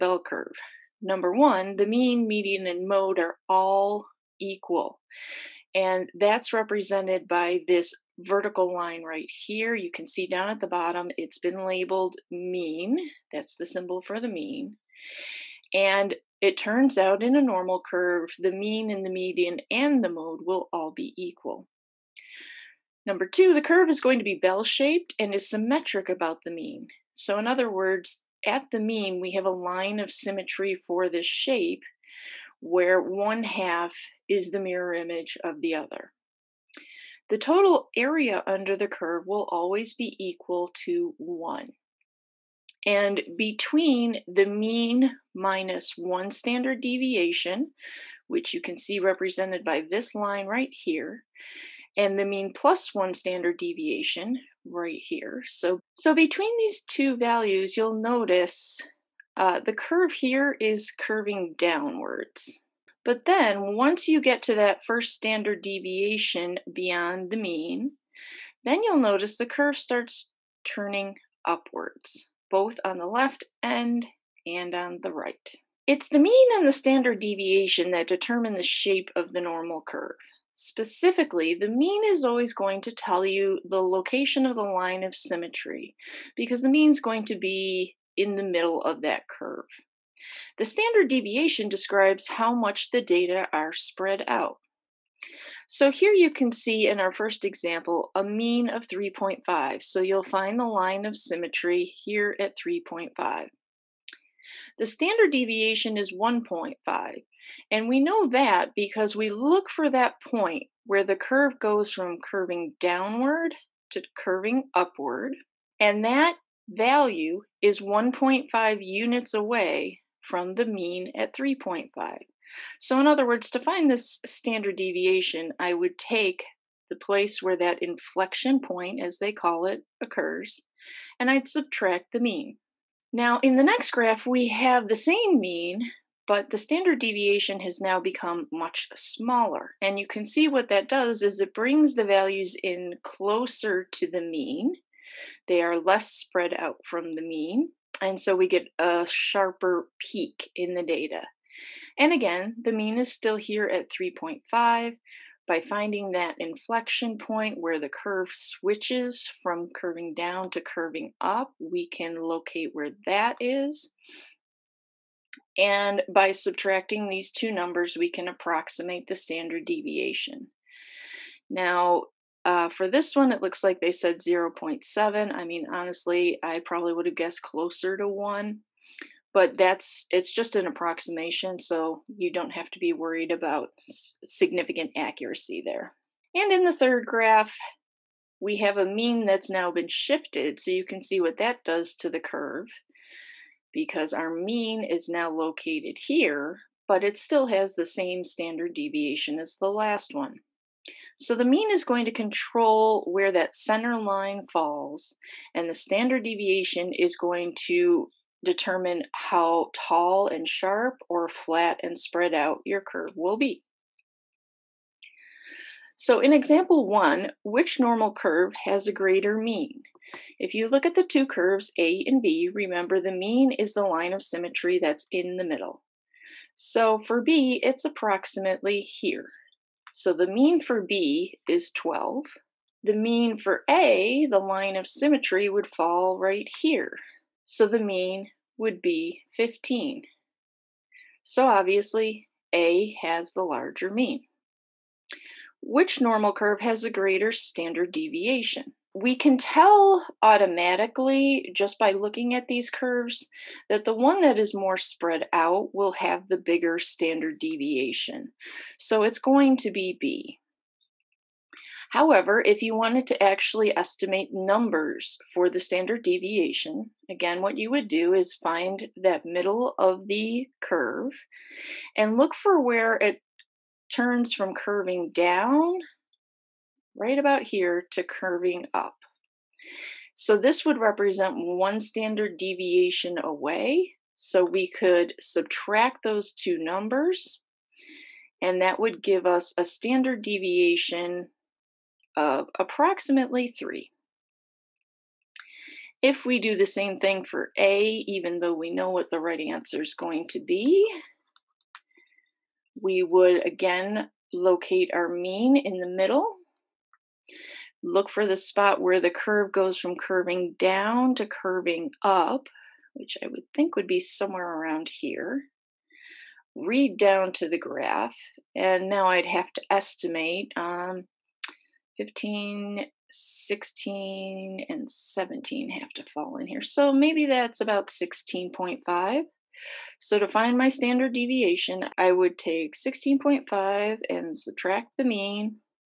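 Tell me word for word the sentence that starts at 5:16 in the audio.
Read down to the graph, and now I'd have to estimate um, 15, 16, and 17 have to fall in here.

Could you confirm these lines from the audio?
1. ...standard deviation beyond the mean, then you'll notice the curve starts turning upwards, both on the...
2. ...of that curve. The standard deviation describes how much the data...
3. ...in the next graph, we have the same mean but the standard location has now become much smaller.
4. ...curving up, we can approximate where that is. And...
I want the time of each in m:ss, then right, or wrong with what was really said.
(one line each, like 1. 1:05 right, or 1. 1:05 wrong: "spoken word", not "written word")
1. 1:05 right
2. 1:28 right
3. 2:13 wrong: "deviation", not "location"
4. 2:40 wrong: "locate", not "approximate".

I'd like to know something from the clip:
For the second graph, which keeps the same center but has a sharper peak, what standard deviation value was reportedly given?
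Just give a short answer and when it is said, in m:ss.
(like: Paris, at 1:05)
0.7, at 2:54.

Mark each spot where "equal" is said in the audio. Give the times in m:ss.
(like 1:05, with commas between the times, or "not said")
0:04, 0:21, 0:40.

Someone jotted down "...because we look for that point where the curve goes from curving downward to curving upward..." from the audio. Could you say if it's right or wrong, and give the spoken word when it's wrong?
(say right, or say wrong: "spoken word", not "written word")
right.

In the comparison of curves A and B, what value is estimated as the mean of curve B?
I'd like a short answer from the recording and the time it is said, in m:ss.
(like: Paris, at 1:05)
12, at 3:50.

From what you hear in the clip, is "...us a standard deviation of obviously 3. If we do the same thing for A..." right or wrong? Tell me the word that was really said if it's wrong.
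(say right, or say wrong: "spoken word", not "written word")
wrong: "approximately", not "obviously".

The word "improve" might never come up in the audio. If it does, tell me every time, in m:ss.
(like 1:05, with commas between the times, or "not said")
not said.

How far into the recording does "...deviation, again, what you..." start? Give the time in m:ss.
4:26.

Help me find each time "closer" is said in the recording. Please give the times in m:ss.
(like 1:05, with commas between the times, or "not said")
2:23, 2:57.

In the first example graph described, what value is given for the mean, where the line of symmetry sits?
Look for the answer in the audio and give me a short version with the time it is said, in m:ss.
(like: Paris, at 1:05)
3.5, at 1:38.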